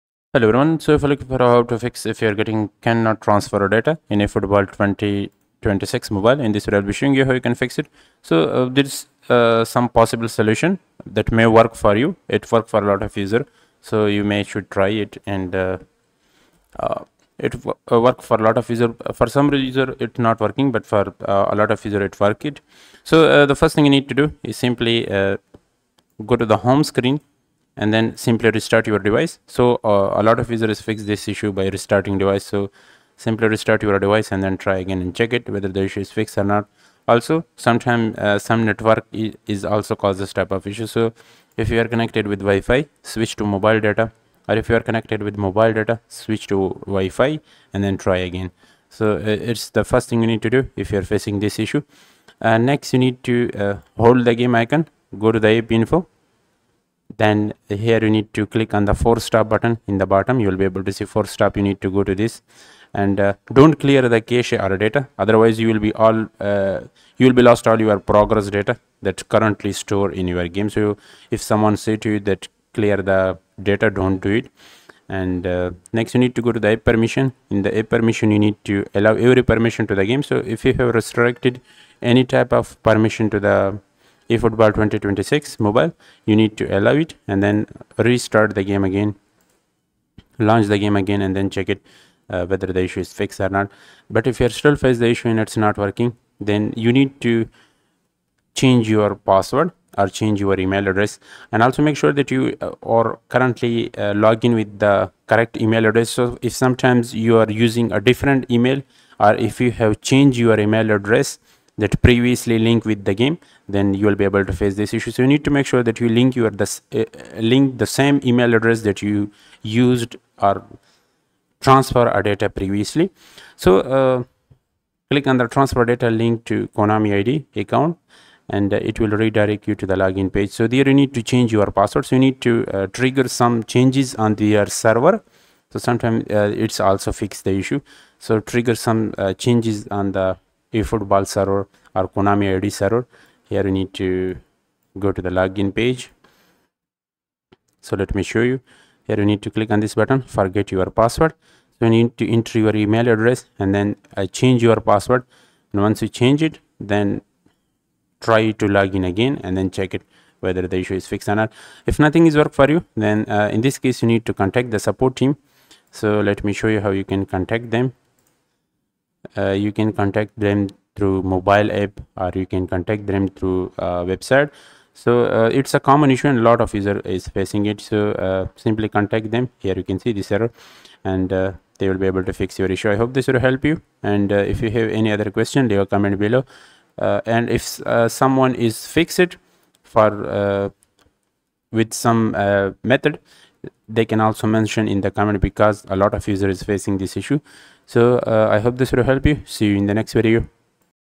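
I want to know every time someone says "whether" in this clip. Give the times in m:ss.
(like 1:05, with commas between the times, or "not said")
0:35, 1:32, 2:40.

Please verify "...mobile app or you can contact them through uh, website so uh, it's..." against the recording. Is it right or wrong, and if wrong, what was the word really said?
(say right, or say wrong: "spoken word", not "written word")
right.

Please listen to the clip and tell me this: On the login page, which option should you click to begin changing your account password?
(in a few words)
Forget your password.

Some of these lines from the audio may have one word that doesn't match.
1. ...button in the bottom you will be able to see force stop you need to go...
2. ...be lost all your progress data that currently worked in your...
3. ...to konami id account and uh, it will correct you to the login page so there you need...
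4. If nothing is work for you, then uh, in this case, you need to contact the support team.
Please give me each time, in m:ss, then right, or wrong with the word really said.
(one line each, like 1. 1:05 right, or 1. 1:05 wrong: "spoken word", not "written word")
1. 0:59 right
2. 1:07 wrong: "stored", not "worked"
3. 2:06 wrong: "redirect", not "correct"
4. 2:41 right.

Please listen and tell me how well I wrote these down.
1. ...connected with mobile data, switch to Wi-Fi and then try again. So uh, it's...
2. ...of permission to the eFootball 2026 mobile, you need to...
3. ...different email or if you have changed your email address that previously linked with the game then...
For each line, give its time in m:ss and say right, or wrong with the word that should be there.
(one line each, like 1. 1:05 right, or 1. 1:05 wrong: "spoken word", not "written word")
1. 0:44 right
2. 1:22 right
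3. 1:47 right.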